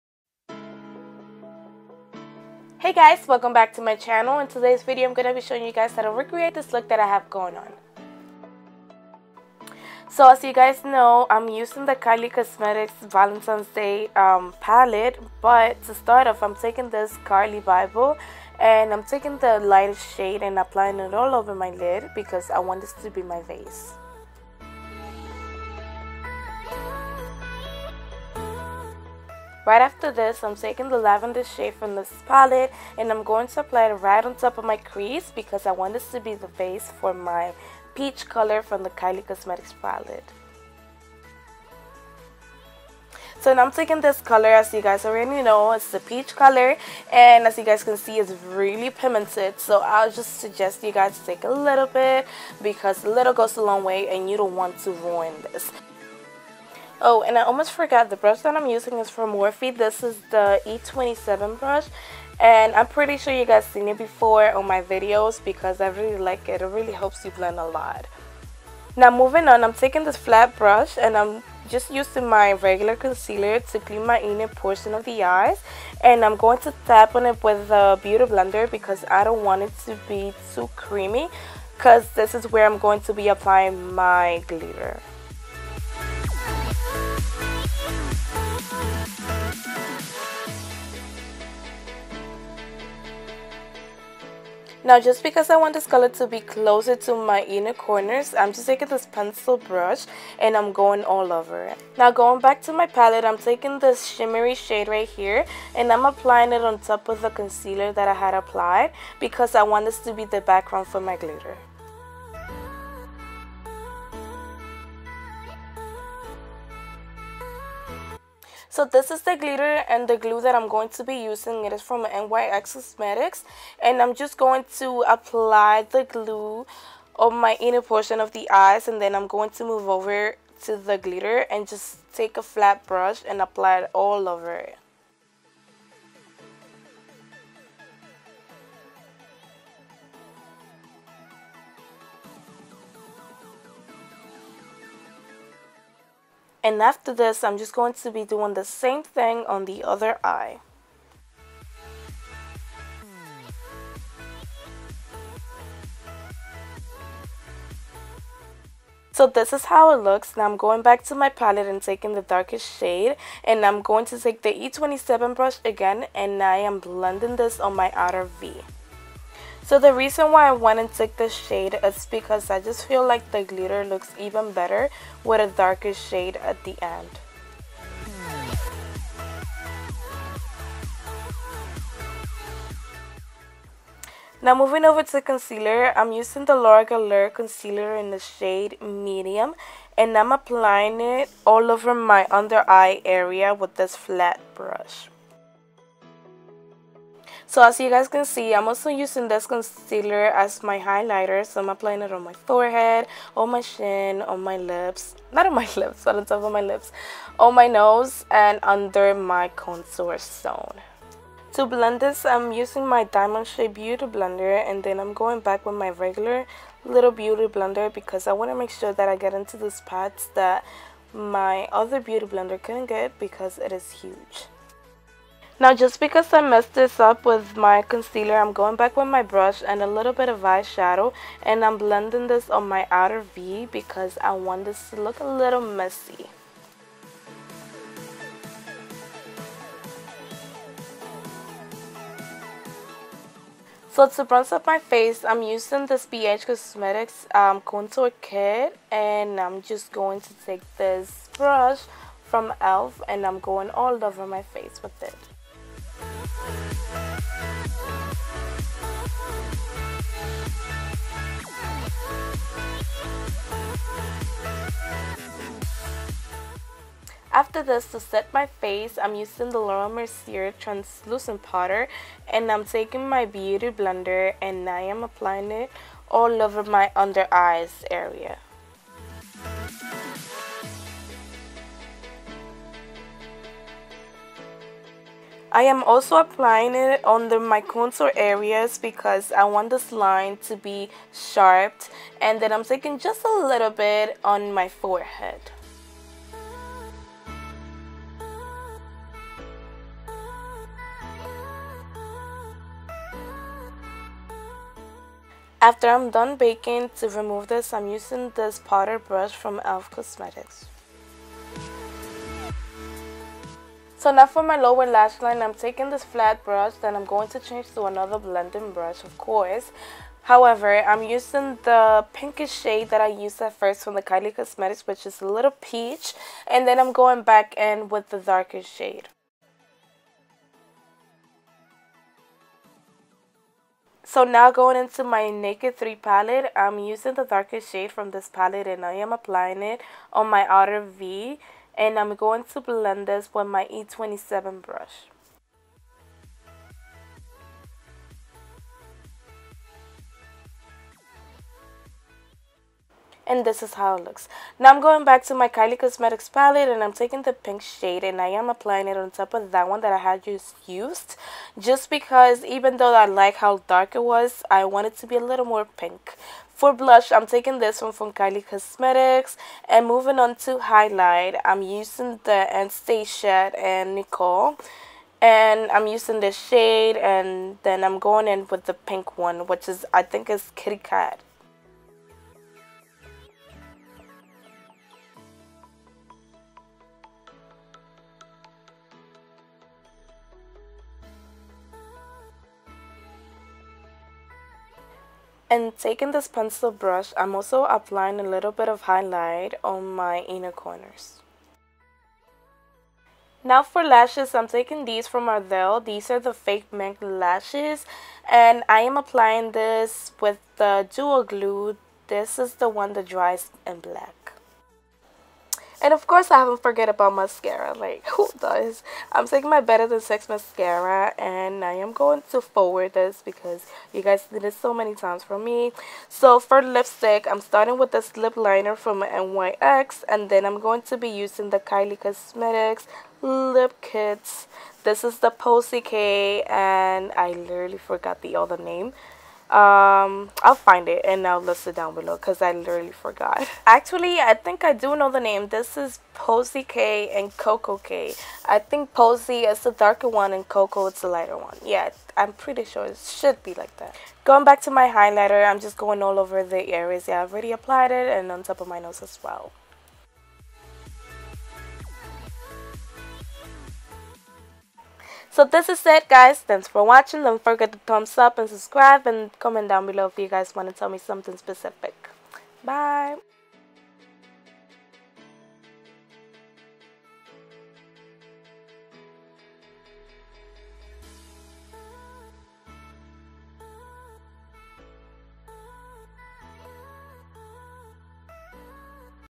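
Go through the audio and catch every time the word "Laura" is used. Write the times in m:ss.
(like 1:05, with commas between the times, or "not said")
3:06, 4:29.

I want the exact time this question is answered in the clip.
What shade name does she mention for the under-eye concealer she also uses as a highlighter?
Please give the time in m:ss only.
3:08.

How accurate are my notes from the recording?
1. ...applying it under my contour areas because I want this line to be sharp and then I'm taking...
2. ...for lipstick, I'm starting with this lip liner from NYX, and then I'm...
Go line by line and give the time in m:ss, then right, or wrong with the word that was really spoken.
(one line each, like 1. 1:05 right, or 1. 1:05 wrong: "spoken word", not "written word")
1. 4:46 right
2. 7:06 right.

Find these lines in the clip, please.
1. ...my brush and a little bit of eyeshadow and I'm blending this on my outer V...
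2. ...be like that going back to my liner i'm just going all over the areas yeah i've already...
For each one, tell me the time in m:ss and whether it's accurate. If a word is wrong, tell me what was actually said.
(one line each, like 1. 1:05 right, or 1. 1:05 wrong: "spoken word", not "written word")
1. 3:49 right
2. 7:33 wrong: "highlighter", not "liner".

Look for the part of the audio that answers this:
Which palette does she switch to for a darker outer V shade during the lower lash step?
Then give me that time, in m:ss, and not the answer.
5:35.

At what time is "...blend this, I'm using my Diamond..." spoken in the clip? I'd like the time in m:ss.
3:31.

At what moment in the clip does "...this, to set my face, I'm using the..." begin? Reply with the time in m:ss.
4:27.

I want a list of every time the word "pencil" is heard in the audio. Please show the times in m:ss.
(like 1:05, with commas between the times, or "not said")
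1:39, 6:36.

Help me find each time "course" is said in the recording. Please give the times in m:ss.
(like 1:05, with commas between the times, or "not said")
5:19, 6:56.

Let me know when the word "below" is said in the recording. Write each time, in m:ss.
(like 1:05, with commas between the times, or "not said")
7:21, 7:49.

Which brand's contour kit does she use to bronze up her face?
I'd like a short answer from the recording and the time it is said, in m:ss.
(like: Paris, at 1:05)
BH Cosmetics, at 4:06.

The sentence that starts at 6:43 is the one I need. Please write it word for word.
Now for lashes, I'm taking these from Ardell.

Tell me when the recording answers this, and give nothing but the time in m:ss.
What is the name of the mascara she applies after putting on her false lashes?
6:59.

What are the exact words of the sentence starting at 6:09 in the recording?
And moving on to highlight, I'm using the Anastasia and Nicole.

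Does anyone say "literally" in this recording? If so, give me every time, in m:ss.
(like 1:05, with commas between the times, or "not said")
7:17, 7:22.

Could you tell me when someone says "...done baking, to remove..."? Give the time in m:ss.
5:06.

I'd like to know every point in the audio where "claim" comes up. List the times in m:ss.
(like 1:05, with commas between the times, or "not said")
not said.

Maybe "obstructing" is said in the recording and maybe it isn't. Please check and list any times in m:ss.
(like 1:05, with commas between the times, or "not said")
not said.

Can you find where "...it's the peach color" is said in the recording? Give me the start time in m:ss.
0:45.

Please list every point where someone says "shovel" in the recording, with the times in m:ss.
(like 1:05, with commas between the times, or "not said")
not said.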